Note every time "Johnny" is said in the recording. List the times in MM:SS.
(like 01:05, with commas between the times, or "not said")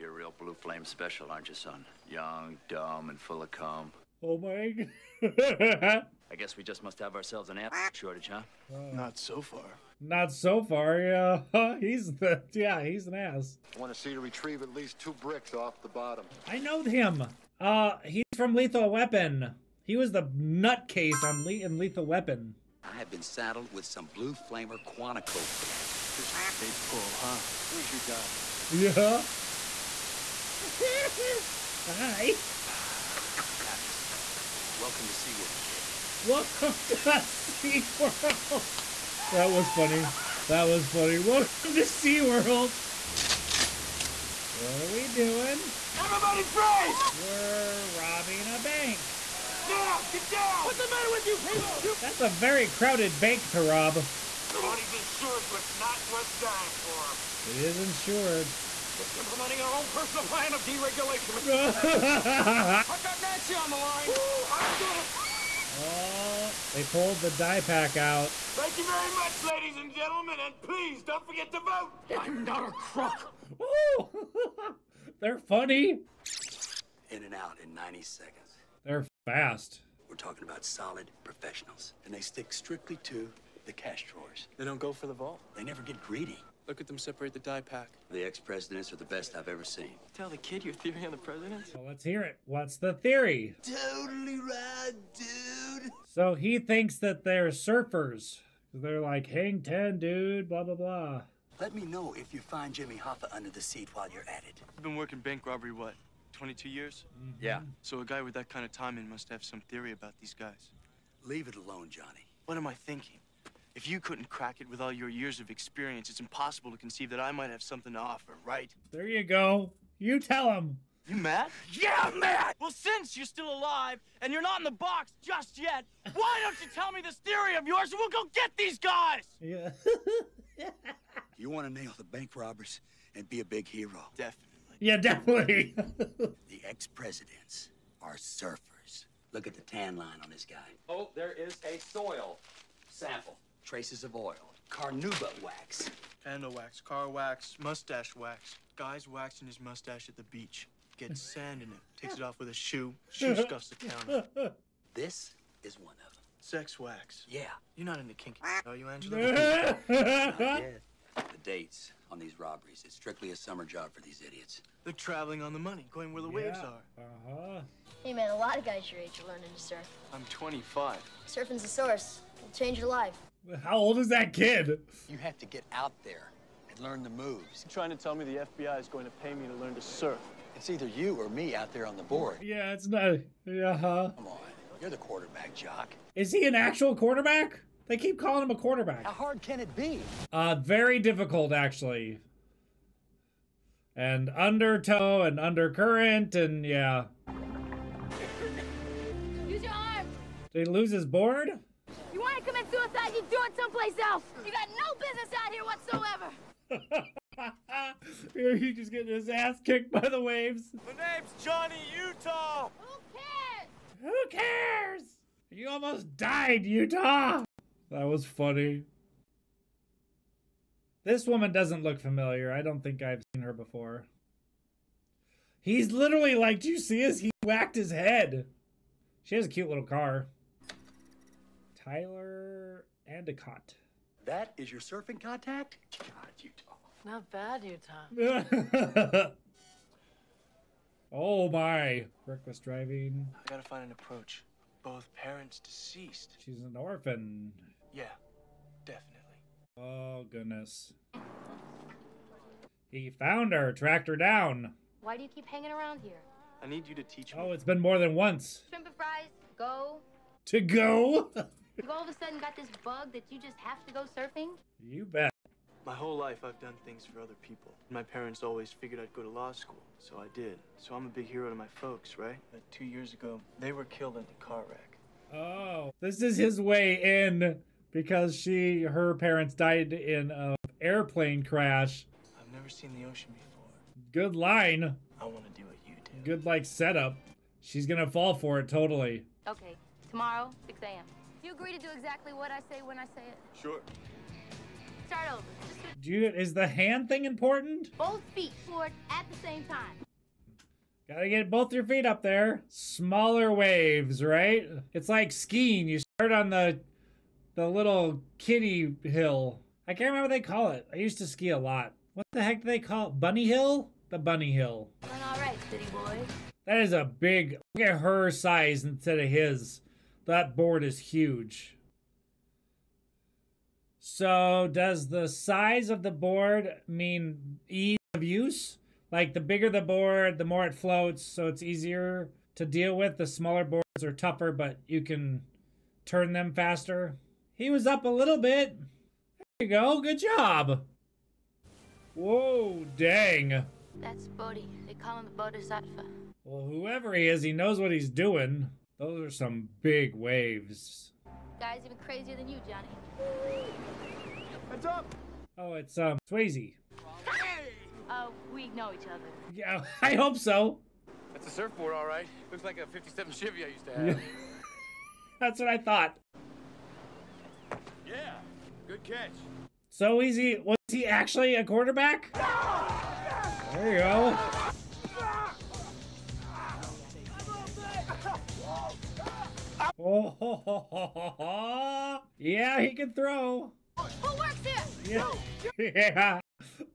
01:51, 03:31, 05:52.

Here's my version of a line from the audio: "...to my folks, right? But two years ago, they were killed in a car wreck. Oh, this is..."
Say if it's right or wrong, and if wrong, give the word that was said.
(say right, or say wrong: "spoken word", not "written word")
right.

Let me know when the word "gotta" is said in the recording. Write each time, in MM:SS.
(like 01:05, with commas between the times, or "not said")
04:03, 05:01.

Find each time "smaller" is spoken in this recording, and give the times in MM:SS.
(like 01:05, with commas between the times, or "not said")
05:02, 05:33.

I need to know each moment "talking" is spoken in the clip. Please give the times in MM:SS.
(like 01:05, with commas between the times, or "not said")
01:20.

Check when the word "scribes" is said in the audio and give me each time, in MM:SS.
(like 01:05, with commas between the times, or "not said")
not said.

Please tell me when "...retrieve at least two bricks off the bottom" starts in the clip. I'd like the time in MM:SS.
00:14.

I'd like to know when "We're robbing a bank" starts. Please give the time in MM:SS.
00:47.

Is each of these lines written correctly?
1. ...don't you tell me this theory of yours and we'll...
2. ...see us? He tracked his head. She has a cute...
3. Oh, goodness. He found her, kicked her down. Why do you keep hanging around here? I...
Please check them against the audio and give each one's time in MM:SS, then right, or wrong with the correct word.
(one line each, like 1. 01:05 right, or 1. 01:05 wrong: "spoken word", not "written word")
1. 02:06 right
2. 03:46 wrong: "whacked", not "tracked"
3. 04:09 wrong: "tracked", not "kicked".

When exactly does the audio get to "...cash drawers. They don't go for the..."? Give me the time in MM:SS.
01:23.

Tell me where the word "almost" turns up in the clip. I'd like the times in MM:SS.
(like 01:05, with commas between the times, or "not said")
03:35.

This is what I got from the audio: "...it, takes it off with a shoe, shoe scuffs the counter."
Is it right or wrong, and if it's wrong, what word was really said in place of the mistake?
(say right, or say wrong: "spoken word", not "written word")
right.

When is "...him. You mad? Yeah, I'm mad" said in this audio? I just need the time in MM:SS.
02:00.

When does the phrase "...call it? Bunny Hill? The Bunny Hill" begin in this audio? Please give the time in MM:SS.
05:12.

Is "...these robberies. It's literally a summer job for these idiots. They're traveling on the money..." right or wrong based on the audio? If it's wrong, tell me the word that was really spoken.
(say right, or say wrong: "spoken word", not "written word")
wrong: "strictly", not "literally".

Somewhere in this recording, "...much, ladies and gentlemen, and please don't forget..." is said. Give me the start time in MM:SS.
01:09.